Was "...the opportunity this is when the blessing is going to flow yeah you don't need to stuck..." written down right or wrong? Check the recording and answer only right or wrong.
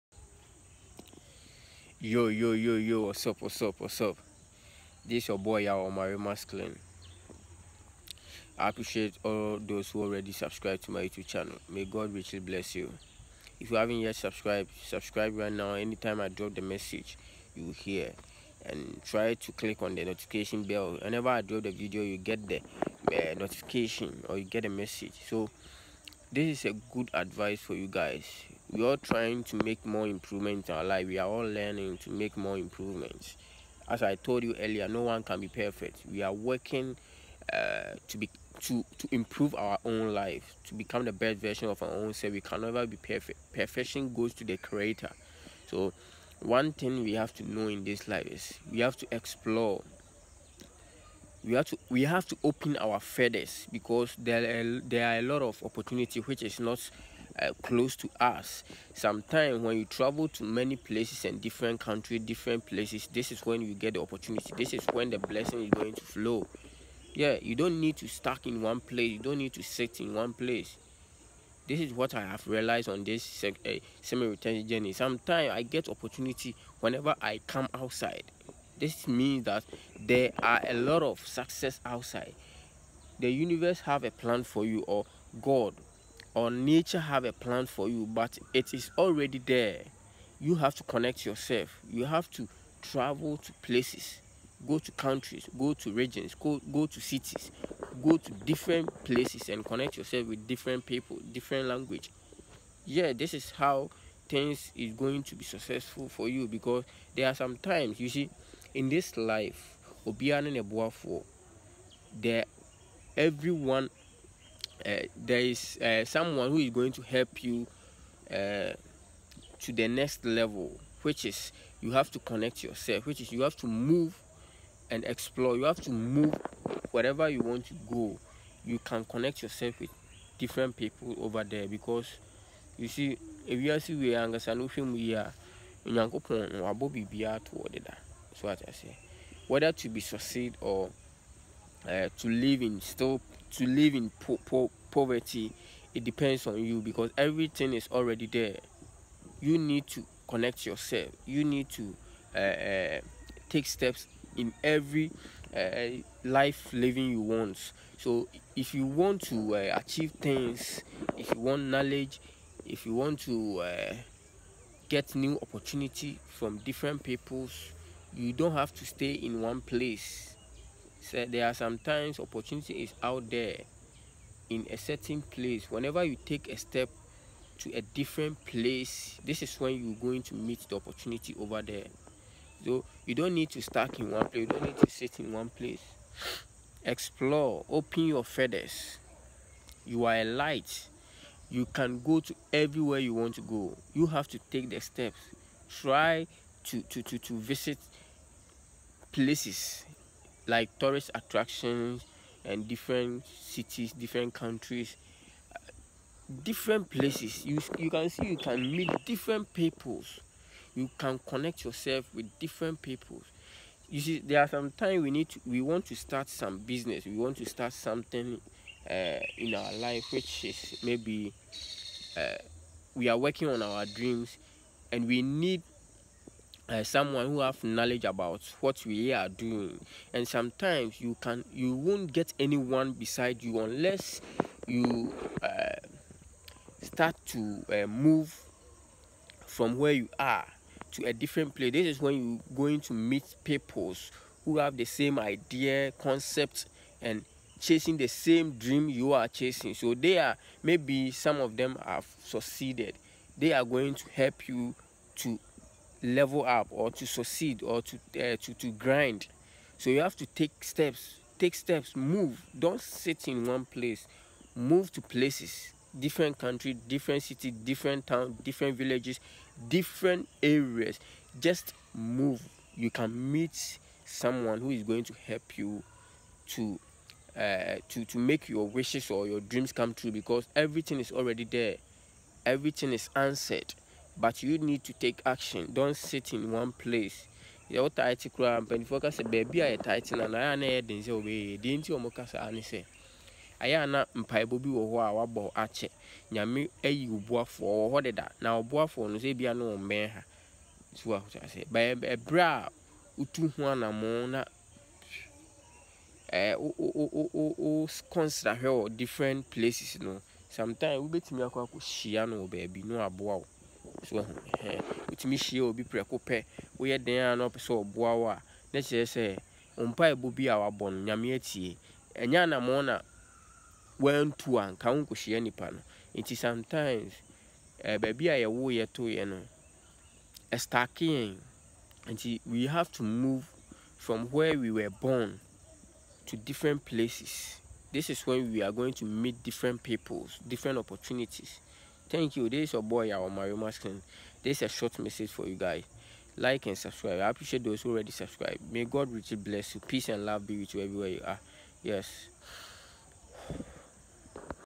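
right.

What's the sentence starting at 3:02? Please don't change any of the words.
So you don't need to stuck in one place.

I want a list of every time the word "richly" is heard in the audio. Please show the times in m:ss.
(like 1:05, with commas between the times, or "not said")
0:12, 5:49.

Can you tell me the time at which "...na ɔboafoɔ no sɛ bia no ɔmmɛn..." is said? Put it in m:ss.
4:58.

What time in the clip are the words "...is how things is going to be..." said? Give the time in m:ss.
1:43.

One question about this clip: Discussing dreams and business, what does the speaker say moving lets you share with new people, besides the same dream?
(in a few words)
same idea concept.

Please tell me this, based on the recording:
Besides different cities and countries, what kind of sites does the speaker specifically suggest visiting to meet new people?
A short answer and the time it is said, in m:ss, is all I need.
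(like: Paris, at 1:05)
tourist attractions, at 3:20.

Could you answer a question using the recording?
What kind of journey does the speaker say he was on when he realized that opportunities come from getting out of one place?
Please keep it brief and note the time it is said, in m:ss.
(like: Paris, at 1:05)
semi-return journey, at 1:14.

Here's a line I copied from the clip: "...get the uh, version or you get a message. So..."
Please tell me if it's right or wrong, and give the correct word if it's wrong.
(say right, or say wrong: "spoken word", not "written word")
wrong: "notification", not "version".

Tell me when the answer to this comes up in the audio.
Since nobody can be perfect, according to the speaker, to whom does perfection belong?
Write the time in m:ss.
0:44.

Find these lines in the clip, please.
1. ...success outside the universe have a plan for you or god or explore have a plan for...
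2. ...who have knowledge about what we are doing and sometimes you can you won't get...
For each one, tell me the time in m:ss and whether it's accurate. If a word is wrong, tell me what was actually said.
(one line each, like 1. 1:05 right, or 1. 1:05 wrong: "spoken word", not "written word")
1. 1:21 wrong: "nature", not "explore"
2. 3:47 right.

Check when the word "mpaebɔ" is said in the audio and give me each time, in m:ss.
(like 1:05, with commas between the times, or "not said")
4:54, 5:19.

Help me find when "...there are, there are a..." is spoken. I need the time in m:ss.
0:54.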